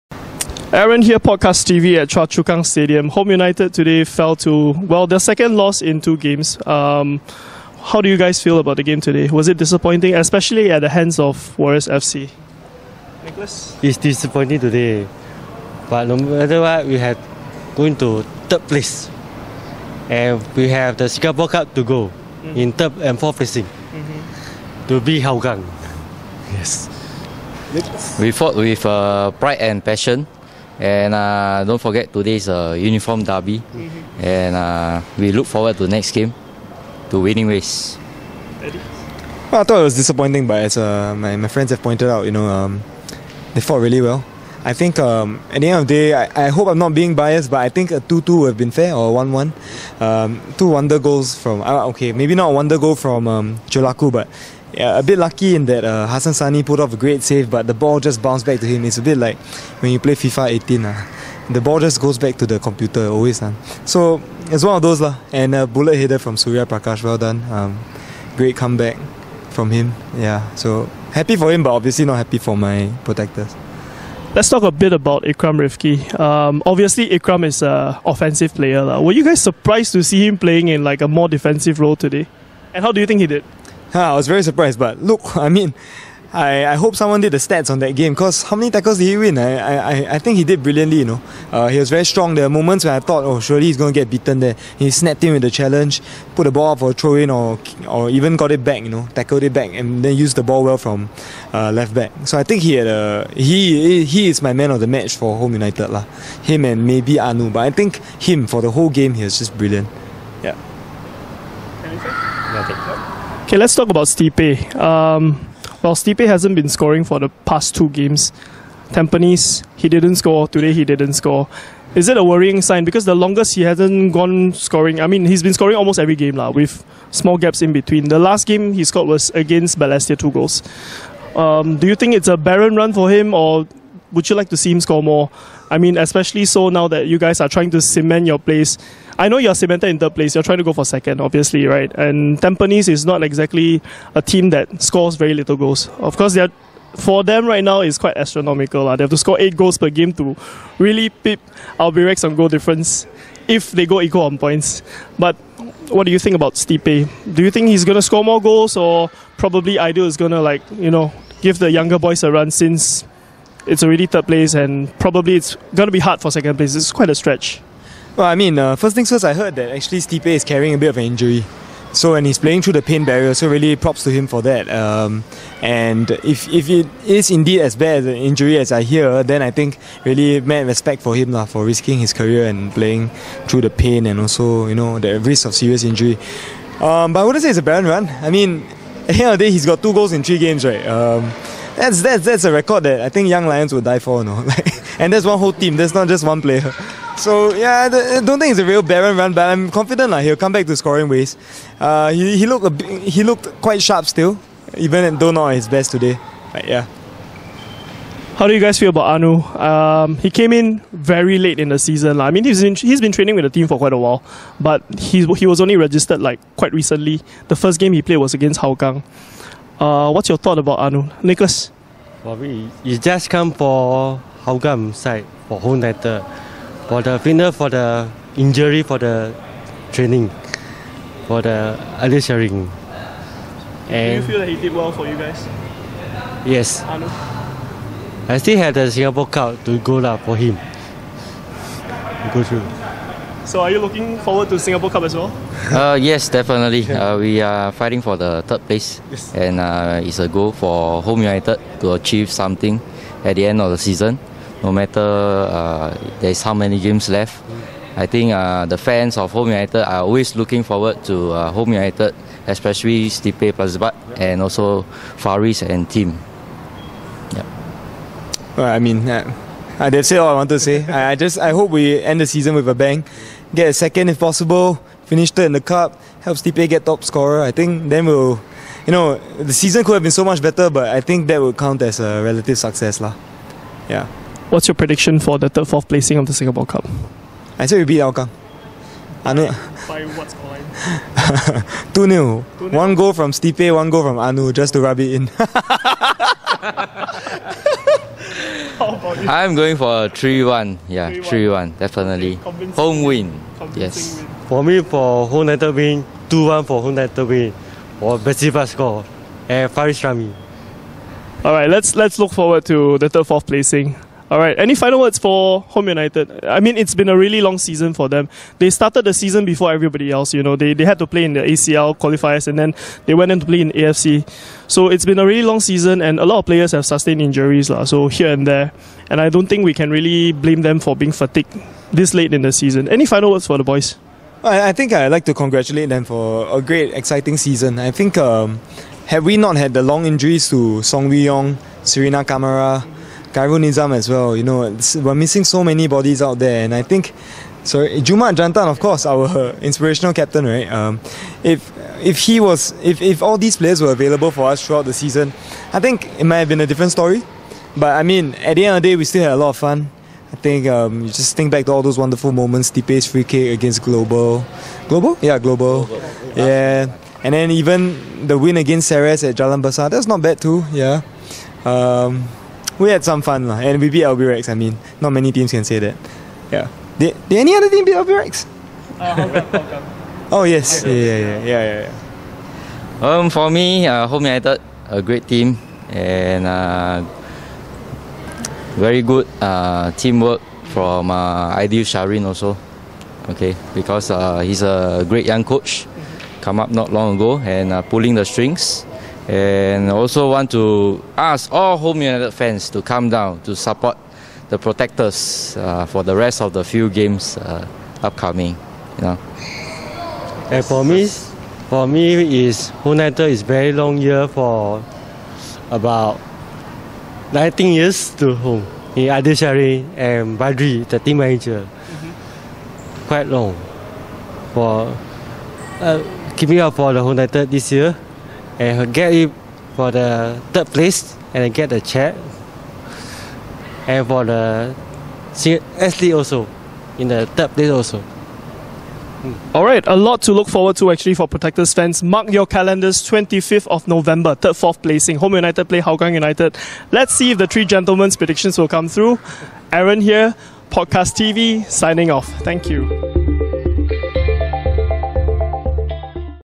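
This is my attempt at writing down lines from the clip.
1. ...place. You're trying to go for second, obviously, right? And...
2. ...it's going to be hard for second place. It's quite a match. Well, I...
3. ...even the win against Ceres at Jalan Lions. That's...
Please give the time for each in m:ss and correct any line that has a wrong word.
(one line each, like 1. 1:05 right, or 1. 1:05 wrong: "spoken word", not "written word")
1. 2:20 right
2. 2:45 wrong: "stretch", not "match"
3. 6:07 wrong: "Besar", not "Lions".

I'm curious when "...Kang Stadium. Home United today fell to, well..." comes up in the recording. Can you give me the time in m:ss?
0:02.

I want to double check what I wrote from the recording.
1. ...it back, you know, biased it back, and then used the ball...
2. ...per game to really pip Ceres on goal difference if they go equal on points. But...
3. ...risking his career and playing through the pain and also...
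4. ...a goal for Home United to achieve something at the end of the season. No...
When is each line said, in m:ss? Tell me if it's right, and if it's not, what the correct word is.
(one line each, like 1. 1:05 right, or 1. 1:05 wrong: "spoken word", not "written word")
1. 1:38 wrong: "tackled", not "biased"
2. 2:29 wrong: "Albirex", not "Ceres"
3. 3:01 right
4. 4:10 right.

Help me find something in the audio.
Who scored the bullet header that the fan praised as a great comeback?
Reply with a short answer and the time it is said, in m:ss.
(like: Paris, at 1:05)
Surya Prakash, at 1:06.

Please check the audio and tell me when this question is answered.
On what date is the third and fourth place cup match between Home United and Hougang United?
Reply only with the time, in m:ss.
7:23.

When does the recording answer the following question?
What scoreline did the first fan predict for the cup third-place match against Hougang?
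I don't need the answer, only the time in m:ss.
4:51.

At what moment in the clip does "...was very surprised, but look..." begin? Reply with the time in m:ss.
1:24.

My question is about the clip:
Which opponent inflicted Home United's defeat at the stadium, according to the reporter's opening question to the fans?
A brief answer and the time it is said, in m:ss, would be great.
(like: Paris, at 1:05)
Warriors FC, at 0:11.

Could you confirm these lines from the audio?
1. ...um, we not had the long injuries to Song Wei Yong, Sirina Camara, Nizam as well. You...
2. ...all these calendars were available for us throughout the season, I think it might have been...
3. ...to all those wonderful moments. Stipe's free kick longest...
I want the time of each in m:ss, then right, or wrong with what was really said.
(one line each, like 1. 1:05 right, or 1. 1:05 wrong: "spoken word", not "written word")
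1. 5:38 right
2. 5:53 wrong: "players", not "calendars"
3. 6:01 wrong: "against", not "longest".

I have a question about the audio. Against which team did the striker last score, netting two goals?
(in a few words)
Balestier.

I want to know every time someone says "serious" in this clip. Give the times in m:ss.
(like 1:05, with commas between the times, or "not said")
3:05.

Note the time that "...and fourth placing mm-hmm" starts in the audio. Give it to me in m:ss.
0:23.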